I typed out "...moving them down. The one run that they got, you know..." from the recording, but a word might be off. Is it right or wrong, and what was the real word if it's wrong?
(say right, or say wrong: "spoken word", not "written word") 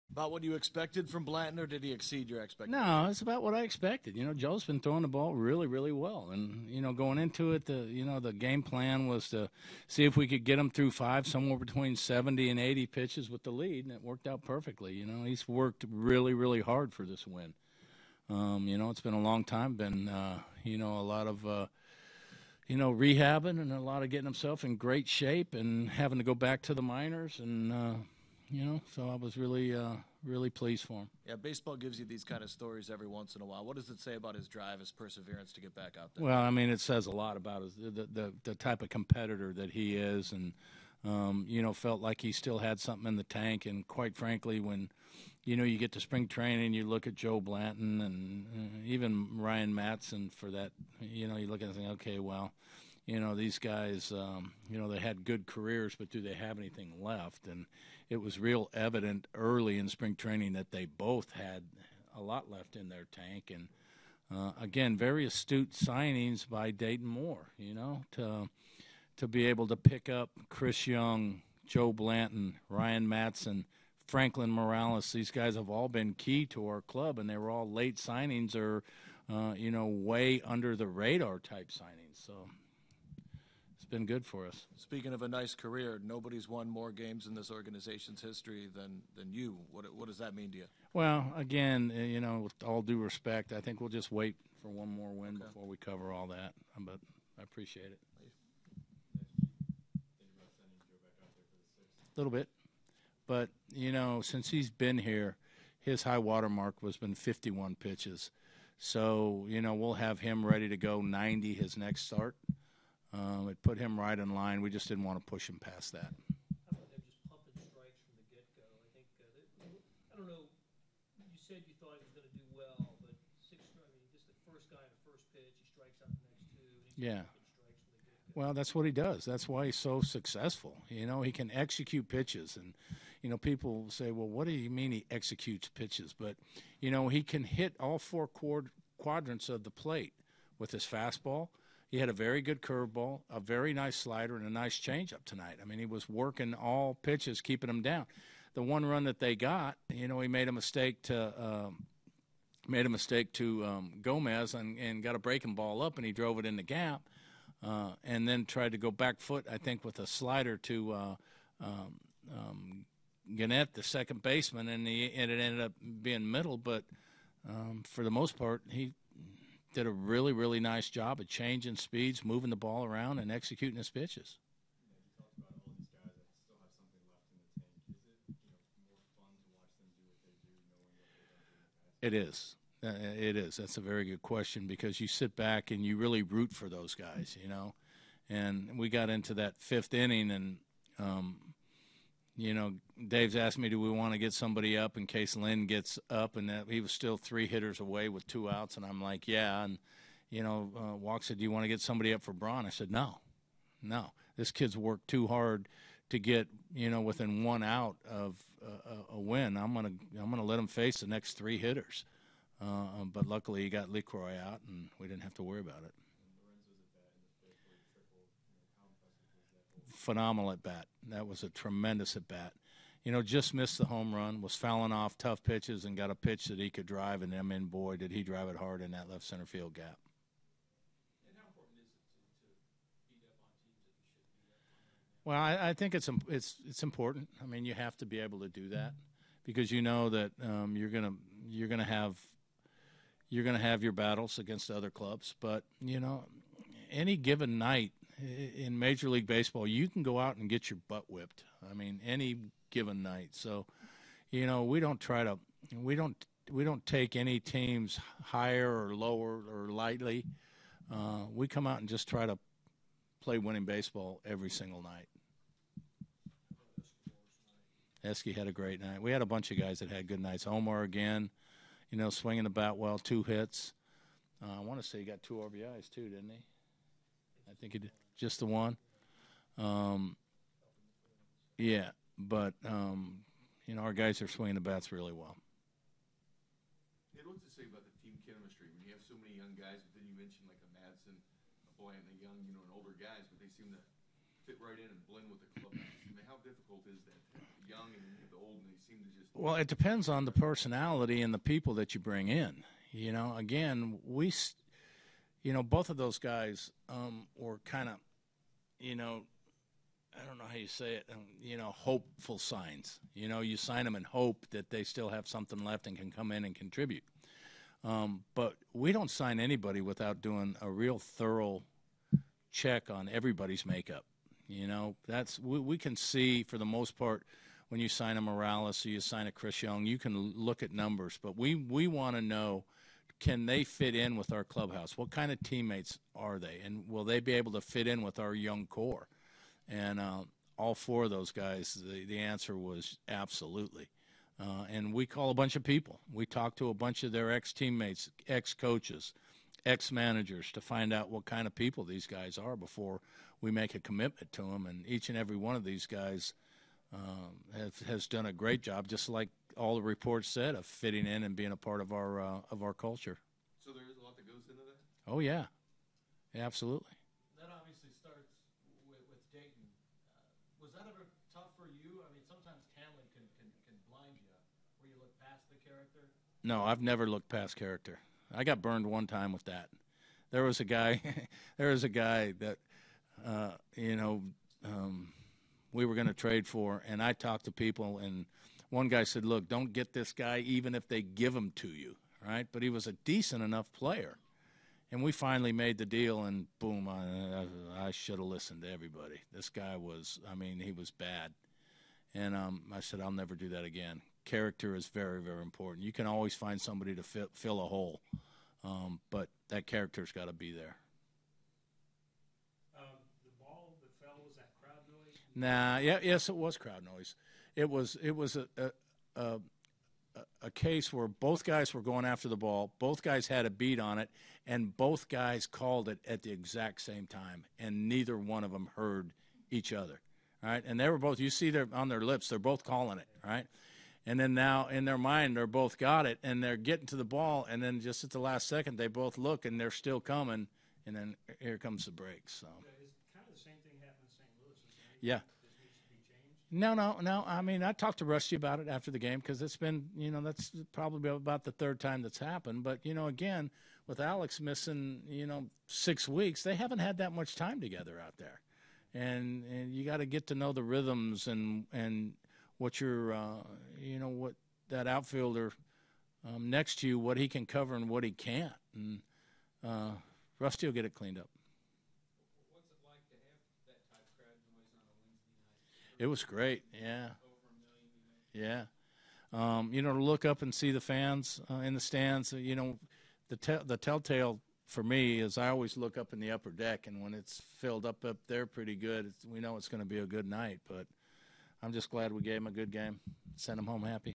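wrong: "keeping", not "moving".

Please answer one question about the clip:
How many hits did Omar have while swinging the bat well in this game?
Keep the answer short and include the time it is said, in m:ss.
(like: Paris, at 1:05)
2, at 4:32.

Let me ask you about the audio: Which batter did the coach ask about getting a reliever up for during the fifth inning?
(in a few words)
Braun.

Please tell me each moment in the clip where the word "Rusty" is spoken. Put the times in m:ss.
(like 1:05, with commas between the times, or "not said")
7:28, 7:50.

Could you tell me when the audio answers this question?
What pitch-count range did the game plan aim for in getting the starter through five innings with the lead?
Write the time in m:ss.
0:11.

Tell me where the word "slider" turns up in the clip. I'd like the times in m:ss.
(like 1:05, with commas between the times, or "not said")
2:23, 2:40.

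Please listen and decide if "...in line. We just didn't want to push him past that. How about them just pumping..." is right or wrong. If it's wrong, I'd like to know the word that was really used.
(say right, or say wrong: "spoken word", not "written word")
right.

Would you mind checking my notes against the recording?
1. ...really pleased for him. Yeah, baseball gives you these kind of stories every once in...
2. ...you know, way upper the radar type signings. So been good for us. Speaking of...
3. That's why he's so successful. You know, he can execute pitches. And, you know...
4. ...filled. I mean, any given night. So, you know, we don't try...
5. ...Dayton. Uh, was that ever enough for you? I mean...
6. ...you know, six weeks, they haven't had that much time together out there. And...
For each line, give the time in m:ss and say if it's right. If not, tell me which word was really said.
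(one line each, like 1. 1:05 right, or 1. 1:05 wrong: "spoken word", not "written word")
1. 0:30 right
2. 1:19 wrong: "under", not "upper"
3. 2:09 right
4. 4:11 wrong: "whipped", not "filled"
5. 6:09 wrong: "tough", not "enough"
6. 7:35 right.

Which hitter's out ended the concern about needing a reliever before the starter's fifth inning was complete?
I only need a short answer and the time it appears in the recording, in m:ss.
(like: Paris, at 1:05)
Lucroy, at 3:33.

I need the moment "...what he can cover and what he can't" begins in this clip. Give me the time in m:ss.
7:46.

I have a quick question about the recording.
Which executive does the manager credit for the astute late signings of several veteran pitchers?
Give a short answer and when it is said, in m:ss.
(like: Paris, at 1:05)
Dayton Moore, at 1:06.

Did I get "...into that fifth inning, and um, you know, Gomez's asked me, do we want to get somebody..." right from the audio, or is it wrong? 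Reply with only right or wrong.
wrong.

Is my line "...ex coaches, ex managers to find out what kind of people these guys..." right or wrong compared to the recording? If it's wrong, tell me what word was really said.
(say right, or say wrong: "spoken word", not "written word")
right.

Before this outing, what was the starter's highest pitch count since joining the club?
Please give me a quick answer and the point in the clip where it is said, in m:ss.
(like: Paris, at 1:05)
51, at 1:47.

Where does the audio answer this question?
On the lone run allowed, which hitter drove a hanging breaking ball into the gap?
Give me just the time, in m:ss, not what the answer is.
2:34.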